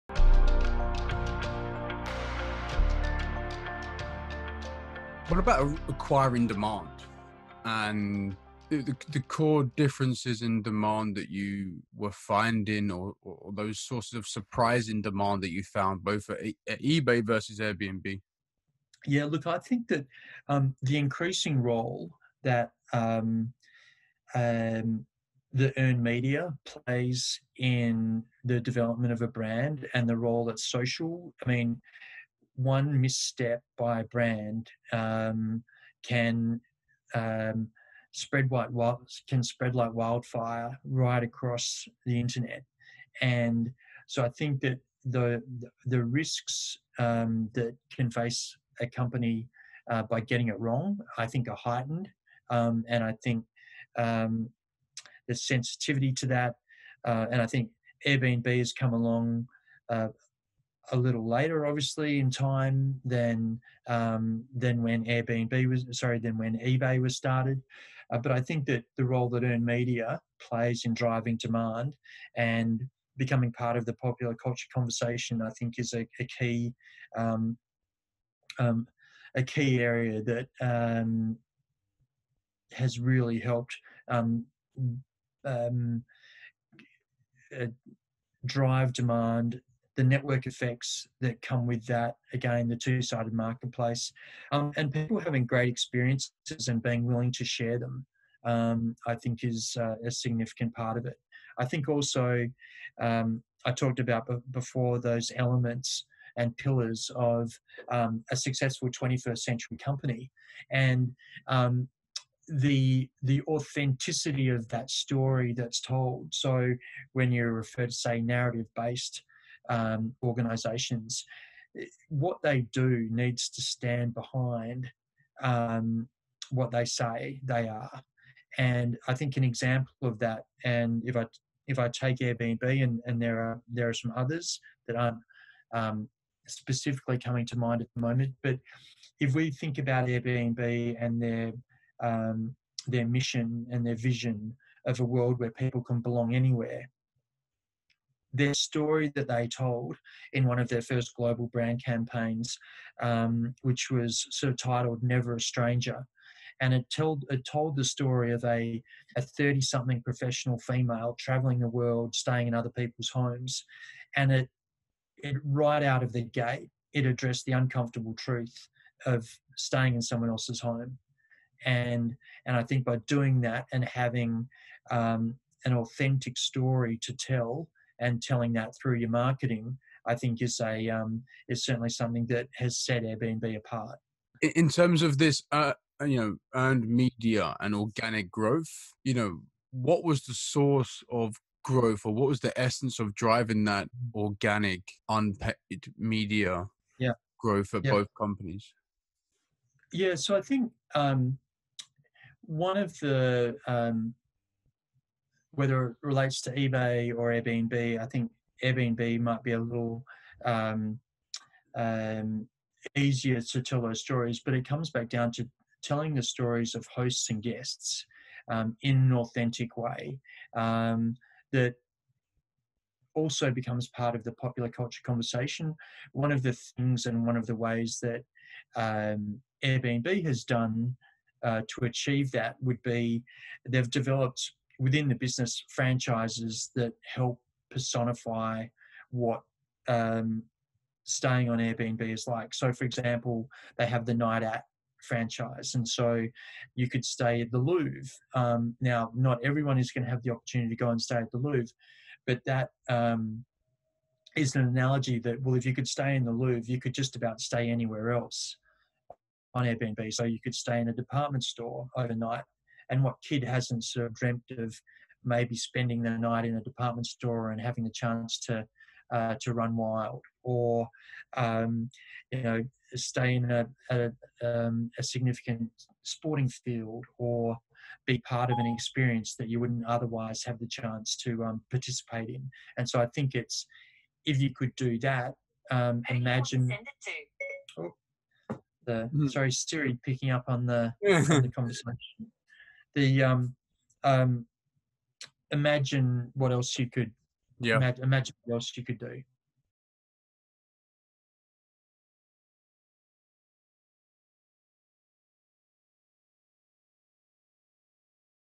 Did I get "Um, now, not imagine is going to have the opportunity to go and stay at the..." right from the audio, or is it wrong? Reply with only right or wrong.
wrong.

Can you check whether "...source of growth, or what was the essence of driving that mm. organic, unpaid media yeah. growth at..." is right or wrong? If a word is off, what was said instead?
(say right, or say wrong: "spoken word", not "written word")
right.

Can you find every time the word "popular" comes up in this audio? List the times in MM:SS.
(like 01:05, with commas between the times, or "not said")
01:13, 03:44.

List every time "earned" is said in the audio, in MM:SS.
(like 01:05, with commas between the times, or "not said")
00:25, 01:09, 03:06.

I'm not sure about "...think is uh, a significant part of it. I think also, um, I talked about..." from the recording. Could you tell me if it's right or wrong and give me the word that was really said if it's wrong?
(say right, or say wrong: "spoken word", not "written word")
right.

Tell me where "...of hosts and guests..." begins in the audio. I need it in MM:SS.
03:36.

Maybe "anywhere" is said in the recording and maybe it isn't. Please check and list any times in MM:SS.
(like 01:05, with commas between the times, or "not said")
02:26, 04:17.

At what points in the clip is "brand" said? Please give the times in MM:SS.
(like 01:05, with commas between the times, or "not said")
00:29, 00:34, 02:31.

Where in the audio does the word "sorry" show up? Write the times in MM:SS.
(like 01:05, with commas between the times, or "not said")
01:05, 04:49.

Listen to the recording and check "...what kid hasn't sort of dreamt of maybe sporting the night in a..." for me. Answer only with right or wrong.
wrong.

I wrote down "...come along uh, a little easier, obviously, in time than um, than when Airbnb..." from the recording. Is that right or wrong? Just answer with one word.
wrong.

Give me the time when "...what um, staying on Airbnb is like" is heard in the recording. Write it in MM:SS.
03:59.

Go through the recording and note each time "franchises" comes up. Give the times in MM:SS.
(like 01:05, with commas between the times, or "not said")
03:55, 04:05.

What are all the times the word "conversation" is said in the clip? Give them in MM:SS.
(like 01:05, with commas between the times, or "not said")
01:14, 03:45, 04:51.